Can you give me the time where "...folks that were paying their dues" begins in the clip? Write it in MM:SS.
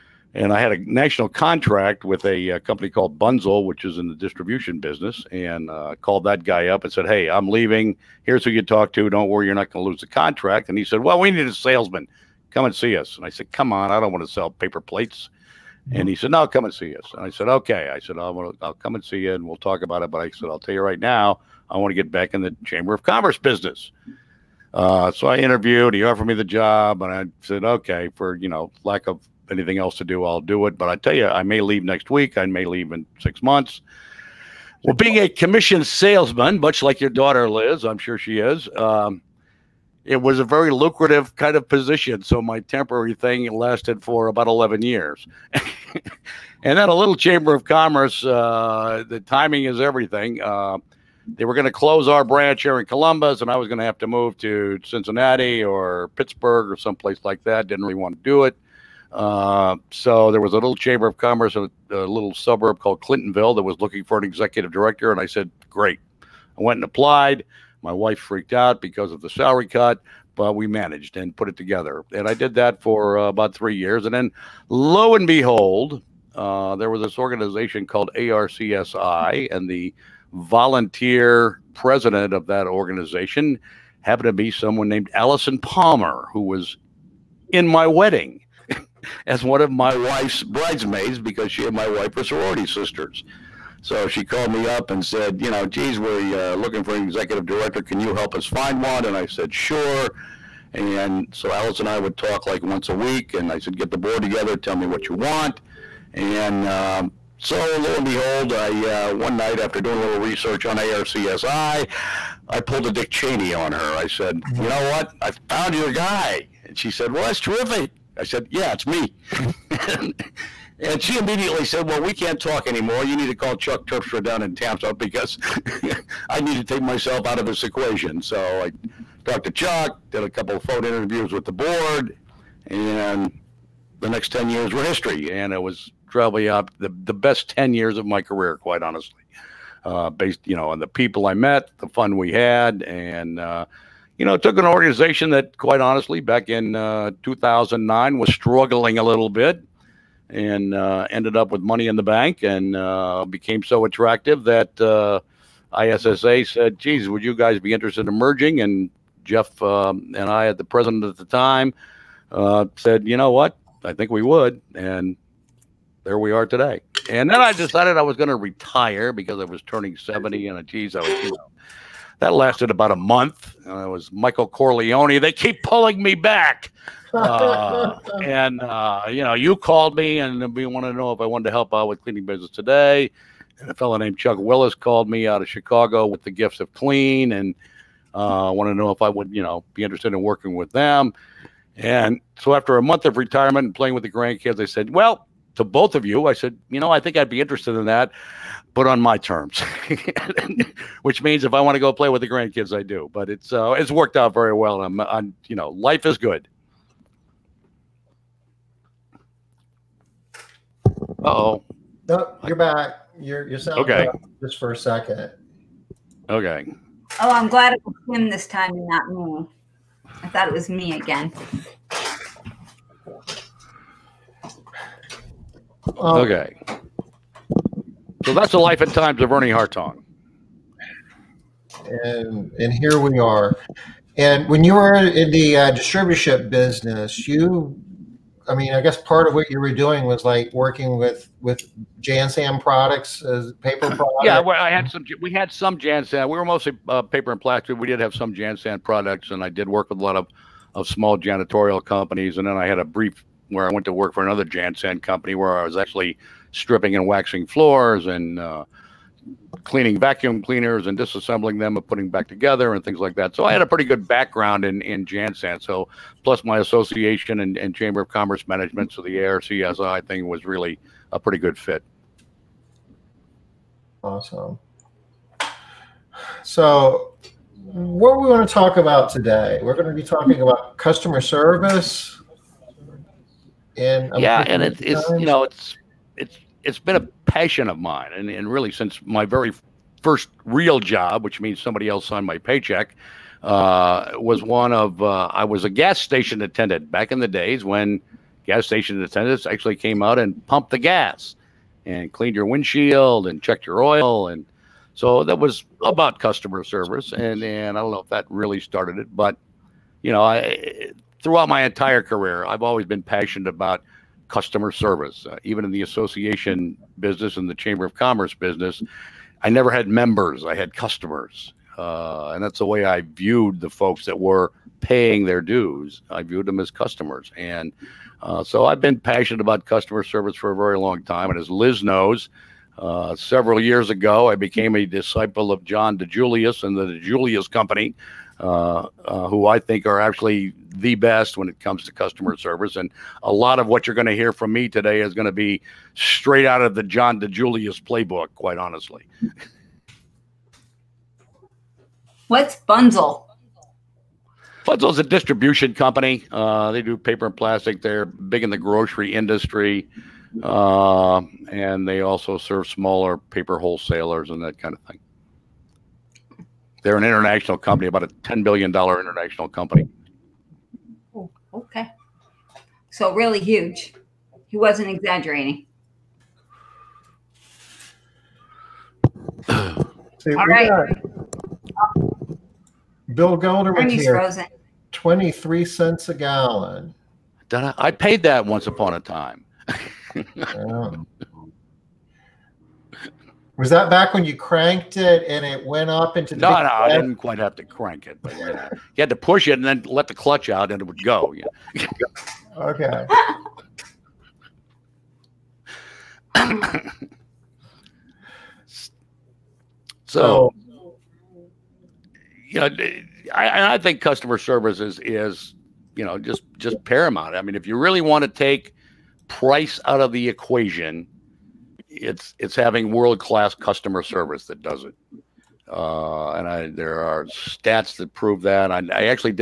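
05:23.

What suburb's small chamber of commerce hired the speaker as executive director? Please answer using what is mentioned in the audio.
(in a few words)
Clintonville.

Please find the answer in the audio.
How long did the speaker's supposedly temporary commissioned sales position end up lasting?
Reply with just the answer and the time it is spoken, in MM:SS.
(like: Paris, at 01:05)
11 years, at 00:44.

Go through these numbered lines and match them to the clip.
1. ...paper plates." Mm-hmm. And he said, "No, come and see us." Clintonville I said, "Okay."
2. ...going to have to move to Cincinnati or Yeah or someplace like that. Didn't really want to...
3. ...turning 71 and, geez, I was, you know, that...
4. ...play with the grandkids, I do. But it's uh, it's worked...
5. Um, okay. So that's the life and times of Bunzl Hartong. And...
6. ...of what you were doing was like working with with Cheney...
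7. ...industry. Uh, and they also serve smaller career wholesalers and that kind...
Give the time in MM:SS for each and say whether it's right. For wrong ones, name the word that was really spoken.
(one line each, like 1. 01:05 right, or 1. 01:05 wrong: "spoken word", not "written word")
1. 00:14 wrong: "And", not "Clintonville"
2. 00:53 wrong: "Pittsburgh", not "Yeah"
3. 02:49 wrong: "70", not "71"
4. 03:21 right
5. 03:45 wrong: "Ernie", not "Bunzl"
6. 03:59 wrong: "Jansan", not "Cheney"
7. 05:59 wrong: "paper", not "career".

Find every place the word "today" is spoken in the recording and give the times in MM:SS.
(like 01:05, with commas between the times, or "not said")
02:46, 03:02, 04:39, 05:44.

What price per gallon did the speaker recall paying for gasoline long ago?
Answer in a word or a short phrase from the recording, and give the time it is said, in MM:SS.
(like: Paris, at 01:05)
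23 cents, at 06:24.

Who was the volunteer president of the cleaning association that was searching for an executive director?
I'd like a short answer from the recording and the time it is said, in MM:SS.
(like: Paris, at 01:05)
Allison Palmer, at 01:25.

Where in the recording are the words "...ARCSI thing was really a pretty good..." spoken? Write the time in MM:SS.
04:29.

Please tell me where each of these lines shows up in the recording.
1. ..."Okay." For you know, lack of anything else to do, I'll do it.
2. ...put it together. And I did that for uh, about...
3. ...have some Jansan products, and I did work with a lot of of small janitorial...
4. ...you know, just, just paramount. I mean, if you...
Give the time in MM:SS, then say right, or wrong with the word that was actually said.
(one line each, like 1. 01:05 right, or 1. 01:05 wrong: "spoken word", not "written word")
1. 00:27 right
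2. 01:11 right
3. 04:07 right
4. 06:55 right.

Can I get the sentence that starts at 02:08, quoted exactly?
So I talked to Chuck, did a couple of phone interviews with the board, and the next 10 years were history.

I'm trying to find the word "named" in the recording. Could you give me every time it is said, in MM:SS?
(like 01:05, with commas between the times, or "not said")
01:24, 03:03.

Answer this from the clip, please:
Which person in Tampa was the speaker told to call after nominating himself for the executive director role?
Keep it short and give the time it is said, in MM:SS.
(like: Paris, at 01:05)
Chuck Terpstra, at 02:03.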